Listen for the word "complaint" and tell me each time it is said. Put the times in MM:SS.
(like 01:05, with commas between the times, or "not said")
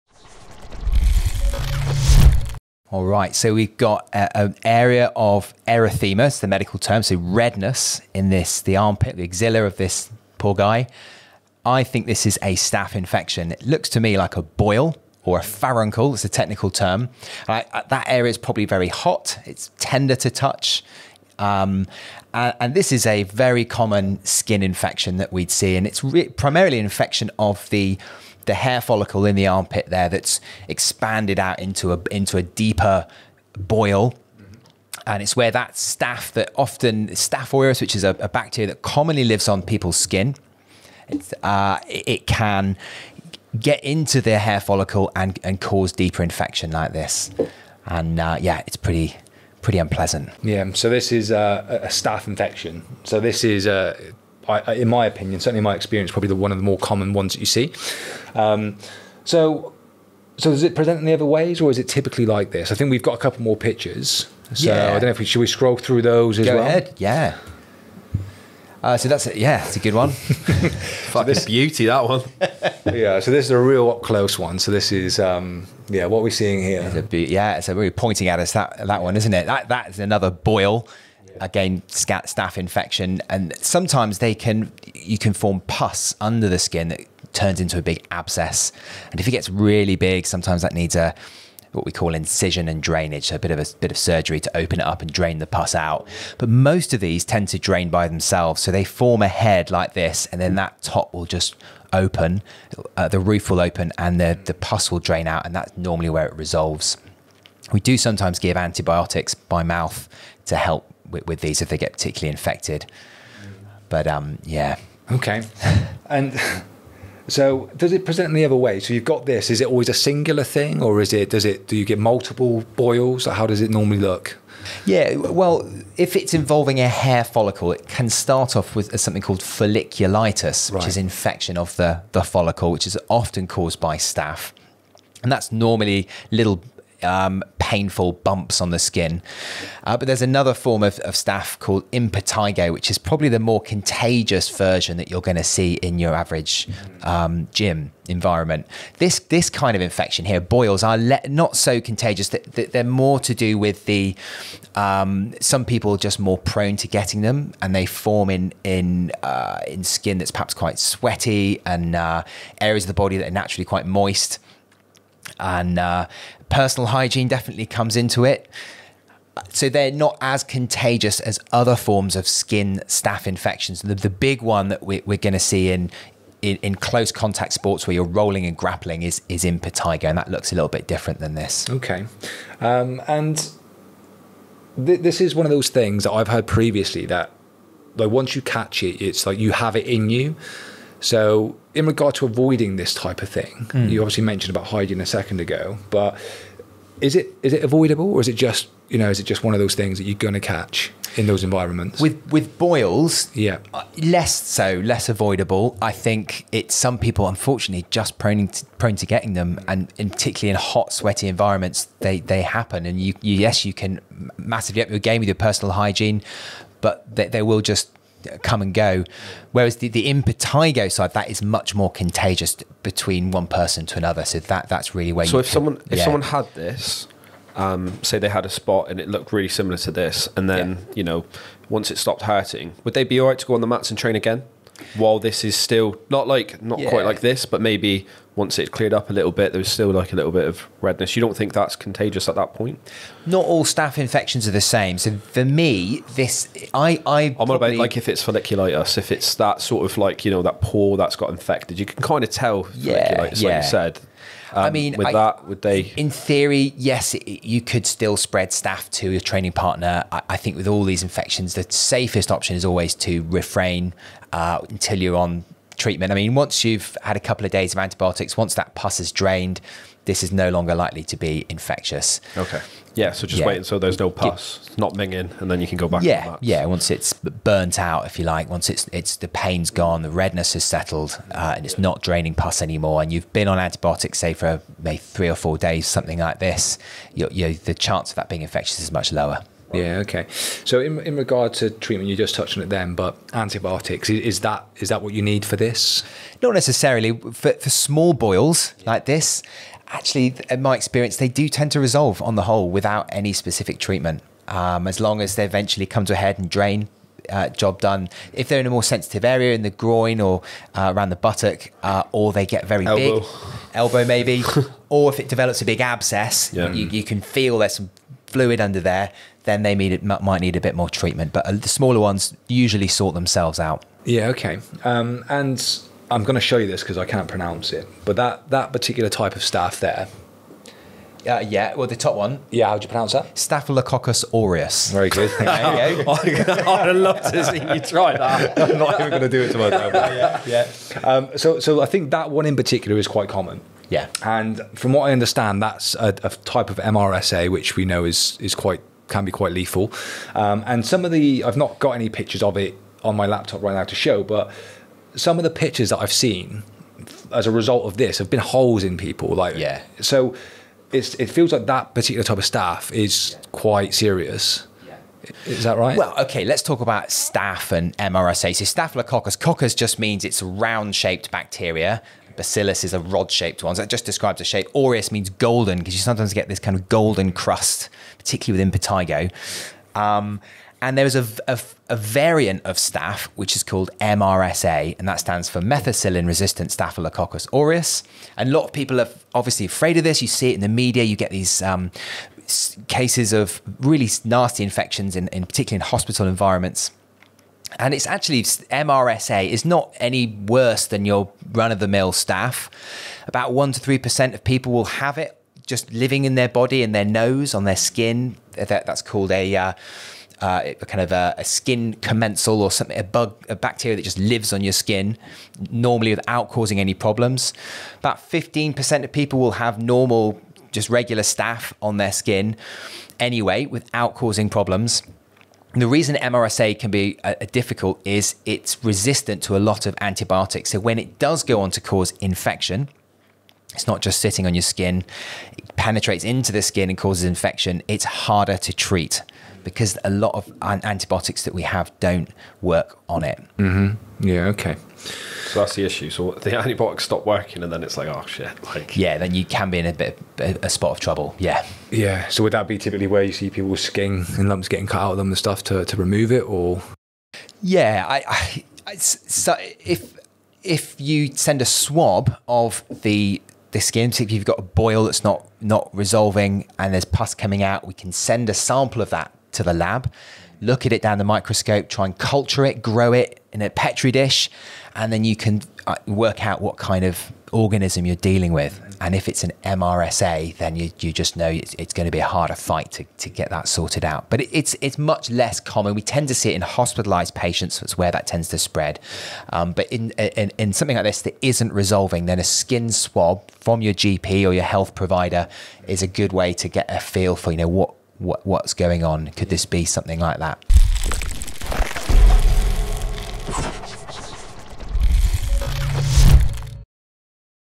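not said.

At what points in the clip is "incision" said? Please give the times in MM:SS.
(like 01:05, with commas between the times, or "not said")
01:32.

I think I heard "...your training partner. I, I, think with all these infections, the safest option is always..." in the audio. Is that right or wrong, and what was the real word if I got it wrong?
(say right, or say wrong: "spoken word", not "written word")
right.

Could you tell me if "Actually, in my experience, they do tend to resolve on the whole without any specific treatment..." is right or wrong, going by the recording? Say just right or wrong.
right.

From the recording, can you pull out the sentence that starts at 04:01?
You don't think that's contagious at that point?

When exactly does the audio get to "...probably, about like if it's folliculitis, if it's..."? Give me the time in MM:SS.
04:07.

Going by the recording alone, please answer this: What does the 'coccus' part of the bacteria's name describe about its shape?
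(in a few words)
round shaped.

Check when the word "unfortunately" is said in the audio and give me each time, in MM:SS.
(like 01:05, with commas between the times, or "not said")
03:27.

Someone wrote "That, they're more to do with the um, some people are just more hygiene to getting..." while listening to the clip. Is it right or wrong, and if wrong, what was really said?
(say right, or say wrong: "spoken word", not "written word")
wrong: "prone", not "hygiene".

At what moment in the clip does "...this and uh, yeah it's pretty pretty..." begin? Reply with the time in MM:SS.
00:46.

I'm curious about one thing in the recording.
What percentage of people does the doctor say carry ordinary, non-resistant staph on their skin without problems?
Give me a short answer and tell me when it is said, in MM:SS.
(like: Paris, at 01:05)
15%, at 06:58.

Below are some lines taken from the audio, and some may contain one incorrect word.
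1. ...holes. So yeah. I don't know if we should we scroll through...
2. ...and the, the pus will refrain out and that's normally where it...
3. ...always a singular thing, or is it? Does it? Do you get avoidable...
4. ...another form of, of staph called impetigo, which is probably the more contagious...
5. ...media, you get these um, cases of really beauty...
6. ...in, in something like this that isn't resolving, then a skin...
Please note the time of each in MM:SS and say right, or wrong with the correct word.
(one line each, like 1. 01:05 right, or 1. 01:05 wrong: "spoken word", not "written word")
1. 01:03 wrong: "pictures", not "holes"
2. 01:43 wrong: "drain", not "refrain"
3. 01:59 wrong: "multiple", not "avoidable"
4. 02:20 right
5. 06:30 wrong: "nasty", not "beauty"
6. 08:10 right.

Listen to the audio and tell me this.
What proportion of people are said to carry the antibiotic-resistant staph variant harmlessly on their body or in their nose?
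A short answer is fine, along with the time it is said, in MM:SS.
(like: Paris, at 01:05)
1 to 3%, at 06:43.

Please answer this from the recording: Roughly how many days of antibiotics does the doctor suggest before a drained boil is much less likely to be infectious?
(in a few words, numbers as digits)
3 or 4 days.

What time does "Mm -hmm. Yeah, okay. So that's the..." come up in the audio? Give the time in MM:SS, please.
07:23.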